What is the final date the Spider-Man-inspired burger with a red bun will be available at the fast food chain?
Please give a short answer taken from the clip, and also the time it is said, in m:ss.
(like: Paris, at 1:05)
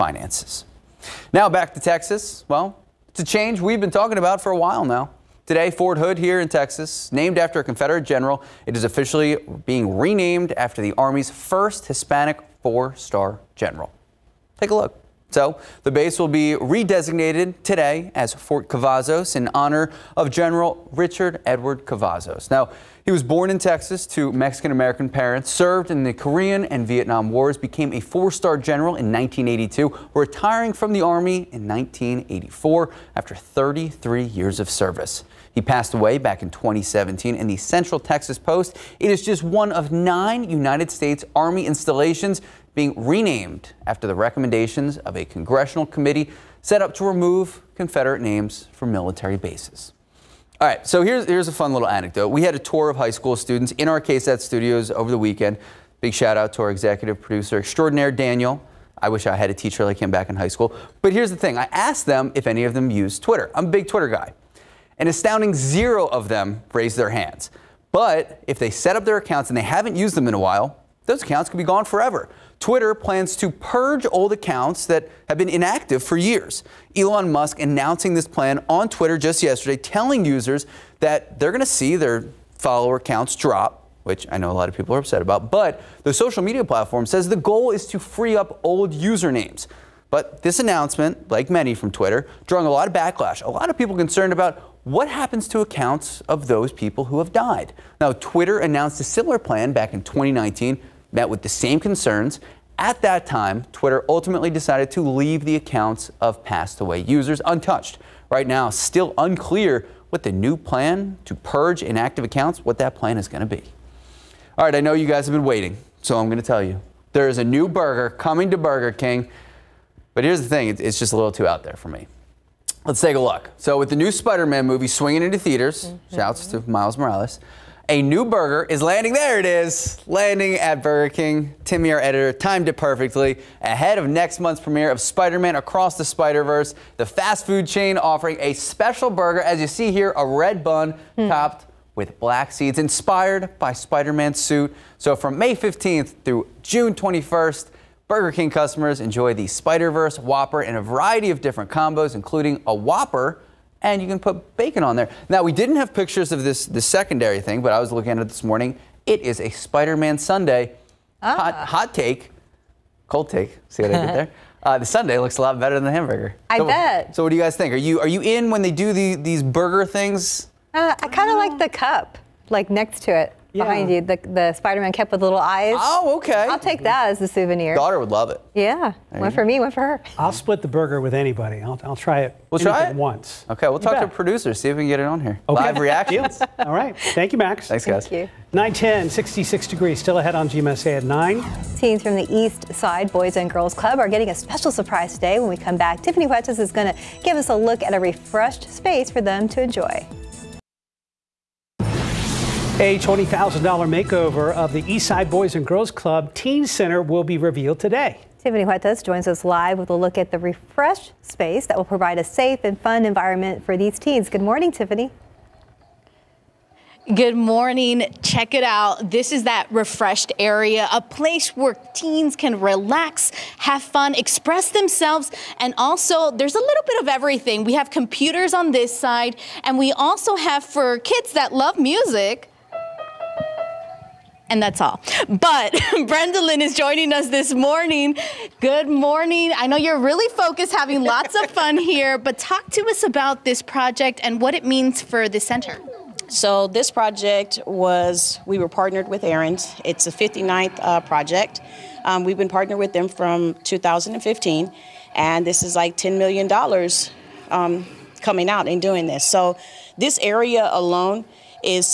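June 21st, at 2:26.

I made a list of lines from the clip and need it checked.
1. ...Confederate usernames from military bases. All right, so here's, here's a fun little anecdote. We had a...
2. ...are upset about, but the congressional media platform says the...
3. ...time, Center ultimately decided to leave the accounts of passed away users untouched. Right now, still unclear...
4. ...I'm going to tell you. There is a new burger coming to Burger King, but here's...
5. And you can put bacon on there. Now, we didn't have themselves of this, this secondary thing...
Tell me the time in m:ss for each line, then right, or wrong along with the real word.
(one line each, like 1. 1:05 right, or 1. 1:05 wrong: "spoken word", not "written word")
1. 0:47 wrong: "names", not "usernames"
2. 1:24 wrong: "social", not "congressional"
3. 1:43 wrong: "Twitter", not "Center"
4. 1:56 right
5. 2:33 wrong: "pictures", not "themselves".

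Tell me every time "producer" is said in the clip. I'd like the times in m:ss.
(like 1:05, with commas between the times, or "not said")
0:57, 3:04.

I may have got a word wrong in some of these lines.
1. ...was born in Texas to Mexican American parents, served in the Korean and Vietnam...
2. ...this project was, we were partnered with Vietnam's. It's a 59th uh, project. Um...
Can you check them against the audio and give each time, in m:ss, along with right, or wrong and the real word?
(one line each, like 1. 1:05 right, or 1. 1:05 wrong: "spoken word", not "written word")
1. 0:23 right
2. 4:06 wrong: "Aaron", not "Vietnam".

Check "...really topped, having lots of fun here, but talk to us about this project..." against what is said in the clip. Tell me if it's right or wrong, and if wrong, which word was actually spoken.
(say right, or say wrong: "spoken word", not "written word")
wrong: "focused", not "topped".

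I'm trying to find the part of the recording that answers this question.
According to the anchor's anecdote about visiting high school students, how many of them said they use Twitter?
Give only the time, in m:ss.
1:05.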